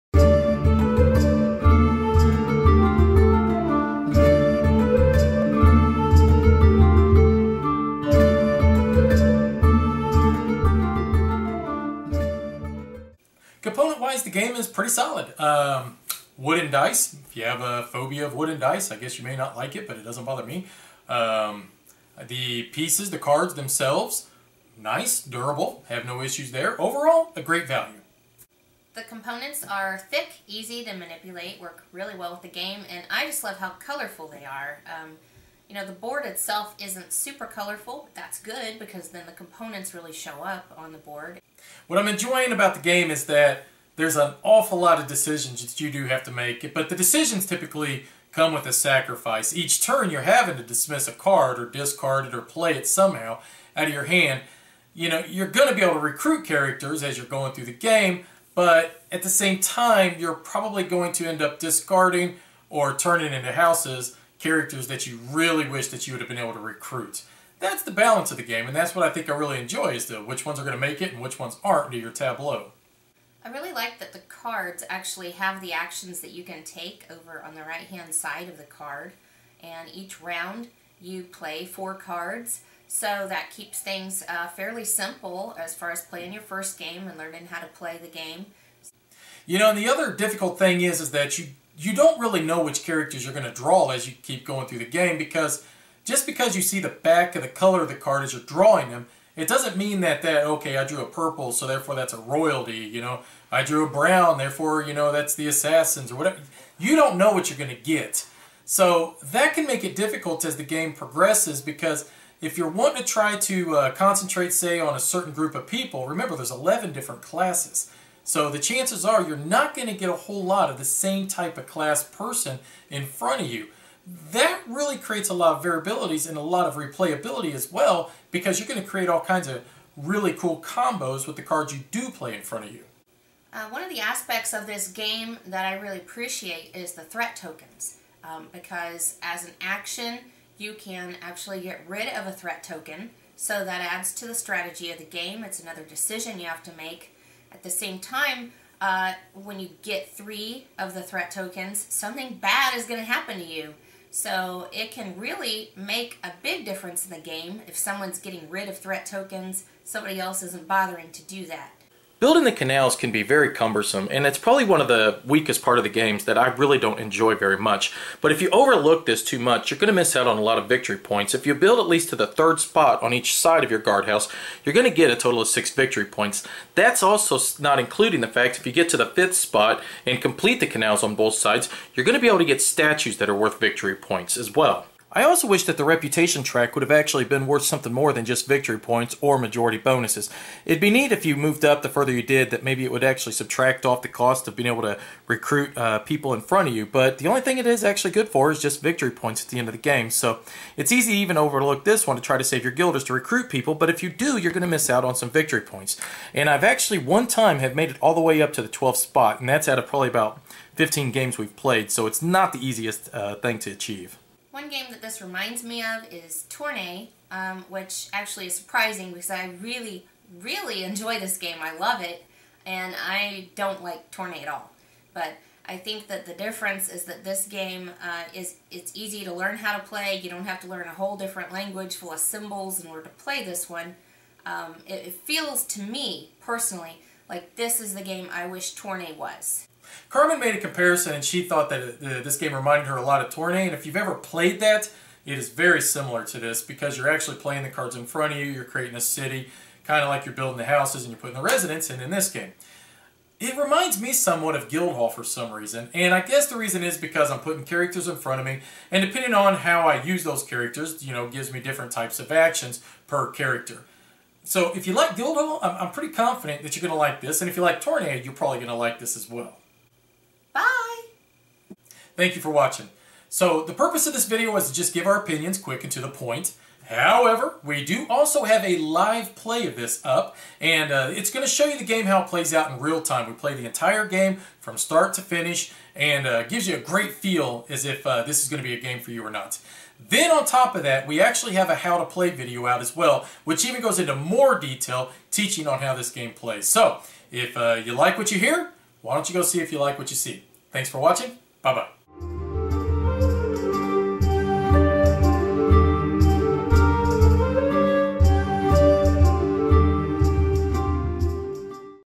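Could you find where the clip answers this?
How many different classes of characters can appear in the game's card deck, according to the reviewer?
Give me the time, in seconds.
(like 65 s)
116 s.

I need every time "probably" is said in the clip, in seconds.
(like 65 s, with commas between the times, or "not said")
60 s, 164 s, 209 s, 268 s.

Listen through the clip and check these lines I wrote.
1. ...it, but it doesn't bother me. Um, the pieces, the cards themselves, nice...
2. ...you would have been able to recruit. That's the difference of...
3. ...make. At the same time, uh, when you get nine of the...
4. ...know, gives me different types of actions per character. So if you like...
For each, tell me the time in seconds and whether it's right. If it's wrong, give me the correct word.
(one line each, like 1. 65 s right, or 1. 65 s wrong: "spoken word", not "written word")
1. 19 s right
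2. 66 s wrong: "balance", not "difference"
3. 146 s wrong: "three", not "nine"
4. 261 s right.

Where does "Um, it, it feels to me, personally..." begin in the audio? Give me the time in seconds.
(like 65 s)
234 s.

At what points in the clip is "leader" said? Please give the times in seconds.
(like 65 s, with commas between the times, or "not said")
not said.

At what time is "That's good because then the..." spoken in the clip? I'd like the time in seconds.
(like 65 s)
38 s.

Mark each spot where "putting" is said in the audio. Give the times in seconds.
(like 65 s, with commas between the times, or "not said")
251 s, 257 s.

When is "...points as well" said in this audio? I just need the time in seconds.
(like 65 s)
183 s.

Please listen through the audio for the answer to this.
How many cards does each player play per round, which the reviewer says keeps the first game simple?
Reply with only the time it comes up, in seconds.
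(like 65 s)
81 s.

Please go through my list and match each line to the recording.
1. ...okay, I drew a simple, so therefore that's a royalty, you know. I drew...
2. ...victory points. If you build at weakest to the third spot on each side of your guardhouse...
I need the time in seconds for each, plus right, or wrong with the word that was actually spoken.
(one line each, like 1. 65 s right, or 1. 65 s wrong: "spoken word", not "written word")
1. 100 s wrong: "purple", not "simple"
2. 170 s wrong: "least", not "weakest".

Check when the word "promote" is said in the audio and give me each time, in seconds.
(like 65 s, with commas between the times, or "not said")
not said.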